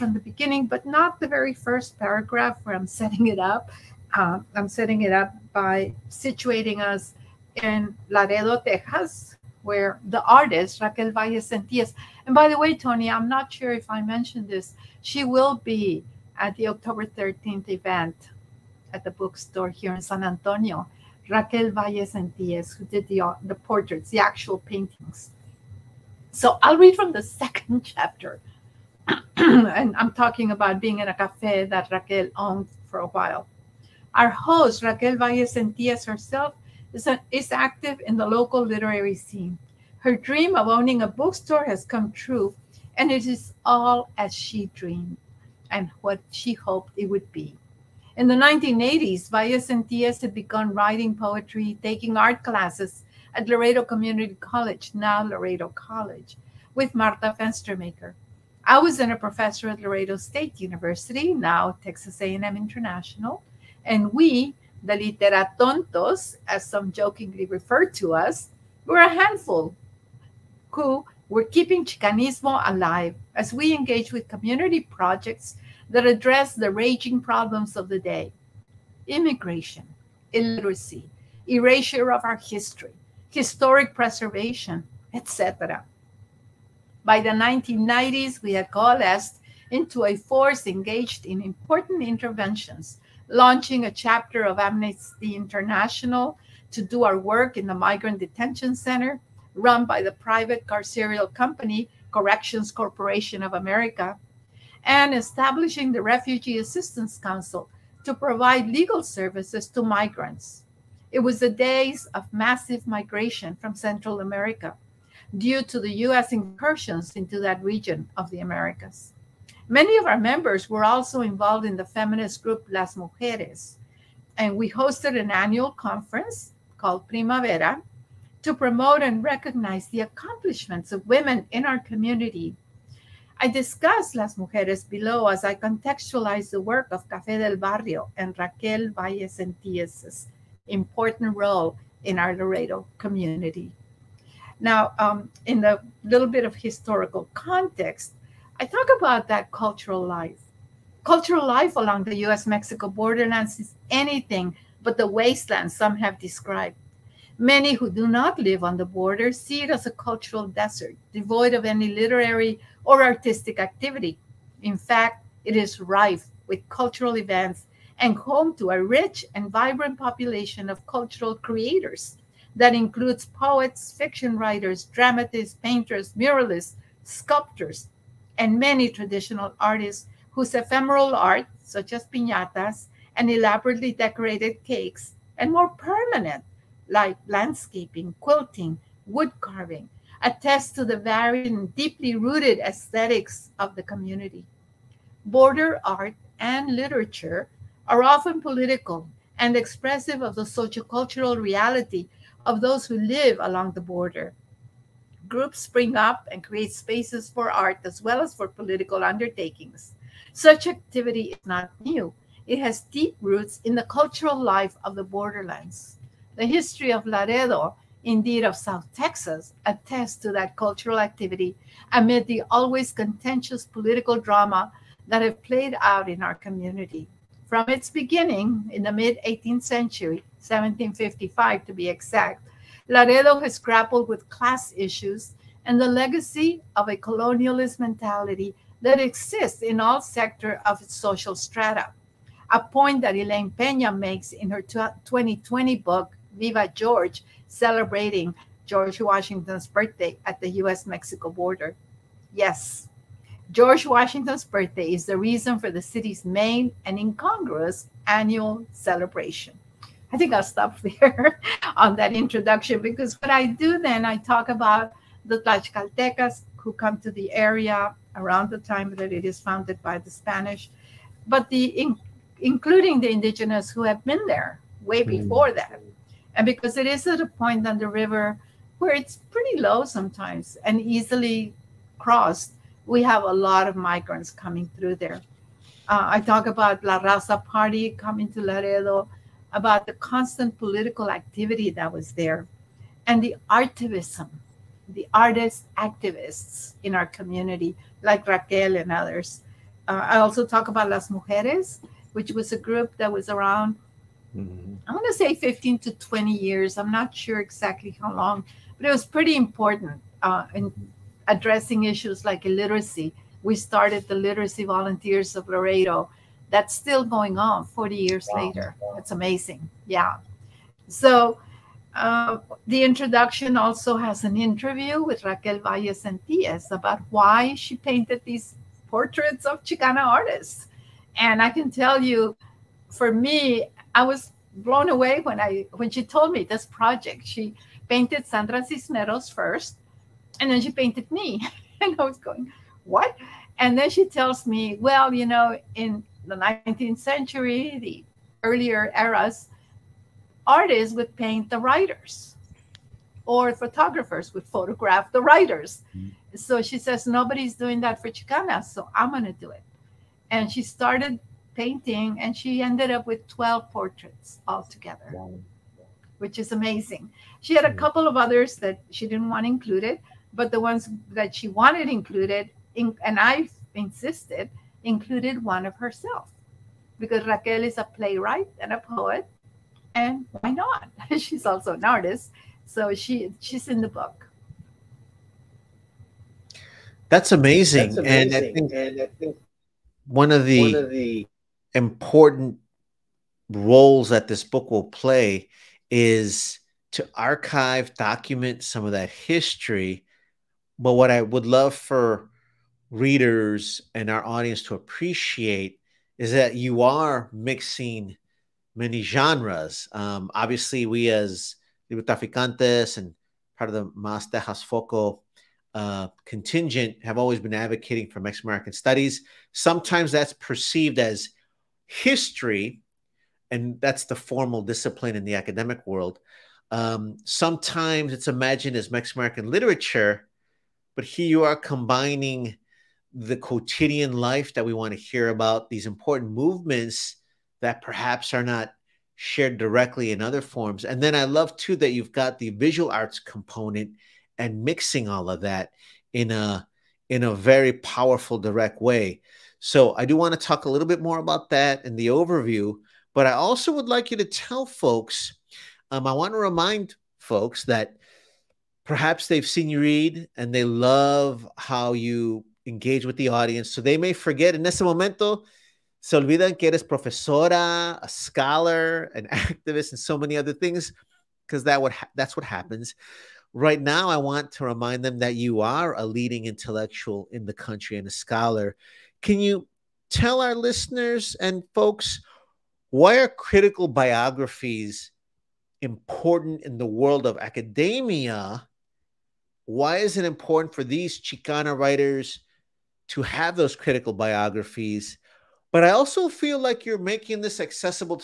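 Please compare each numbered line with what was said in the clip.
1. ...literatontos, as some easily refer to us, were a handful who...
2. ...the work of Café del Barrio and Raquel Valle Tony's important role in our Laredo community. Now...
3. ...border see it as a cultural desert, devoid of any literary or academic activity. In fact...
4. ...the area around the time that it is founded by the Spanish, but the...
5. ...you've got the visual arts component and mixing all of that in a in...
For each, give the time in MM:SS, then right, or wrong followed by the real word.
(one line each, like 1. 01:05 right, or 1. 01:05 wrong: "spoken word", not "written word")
1. 01:04 wrong: "jokingly", not "easily"
2. 02:16 wrong: "Sentíes", not "Tony"
3. 02:38 wrong: "artistic", not "academic"
4. 04:27 right
5. 07:21 right.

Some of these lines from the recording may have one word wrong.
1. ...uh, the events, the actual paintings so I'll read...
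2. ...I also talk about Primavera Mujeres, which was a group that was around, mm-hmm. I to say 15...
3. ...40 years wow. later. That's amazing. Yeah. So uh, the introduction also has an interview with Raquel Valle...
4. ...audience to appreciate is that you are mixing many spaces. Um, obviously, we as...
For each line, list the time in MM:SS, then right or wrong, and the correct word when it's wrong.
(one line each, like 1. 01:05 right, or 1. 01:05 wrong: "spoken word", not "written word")
1. 00:23 wrong: "portraits", not "events"
2. 05:00 wrong: "Las", not "Primavera"
3. 05:17 right
4. 06:44 wrong: "genres", not "spaces".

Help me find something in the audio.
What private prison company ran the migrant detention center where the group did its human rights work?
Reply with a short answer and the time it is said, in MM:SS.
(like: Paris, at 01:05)
Corrections Corporation of America, at 01:42.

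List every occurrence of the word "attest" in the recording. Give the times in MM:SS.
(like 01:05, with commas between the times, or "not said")
03:10, 03:39.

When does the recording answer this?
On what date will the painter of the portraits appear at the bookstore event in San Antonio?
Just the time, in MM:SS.
00:16.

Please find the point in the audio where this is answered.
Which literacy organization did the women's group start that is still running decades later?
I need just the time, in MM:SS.
05:14.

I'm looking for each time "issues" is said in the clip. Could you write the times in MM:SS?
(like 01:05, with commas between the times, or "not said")
03:54, 05:11.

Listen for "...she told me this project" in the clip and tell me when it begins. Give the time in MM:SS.
05:35.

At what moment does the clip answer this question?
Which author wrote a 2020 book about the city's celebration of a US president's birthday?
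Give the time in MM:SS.
04:03.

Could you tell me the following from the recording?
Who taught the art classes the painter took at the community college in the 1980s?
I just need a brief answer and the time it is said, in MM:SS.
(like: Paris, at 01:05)
Martha Fenstermaker, at 00:56.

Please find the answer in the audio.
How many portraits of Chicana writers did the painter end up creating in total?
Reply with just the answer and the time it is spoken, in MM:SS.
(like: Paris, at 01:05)
12, at 06:03.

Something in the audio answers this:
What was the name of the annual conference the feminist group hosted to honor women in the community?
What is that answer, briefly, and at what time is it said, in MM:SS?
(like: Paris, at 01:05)
Primavera, at 02:07.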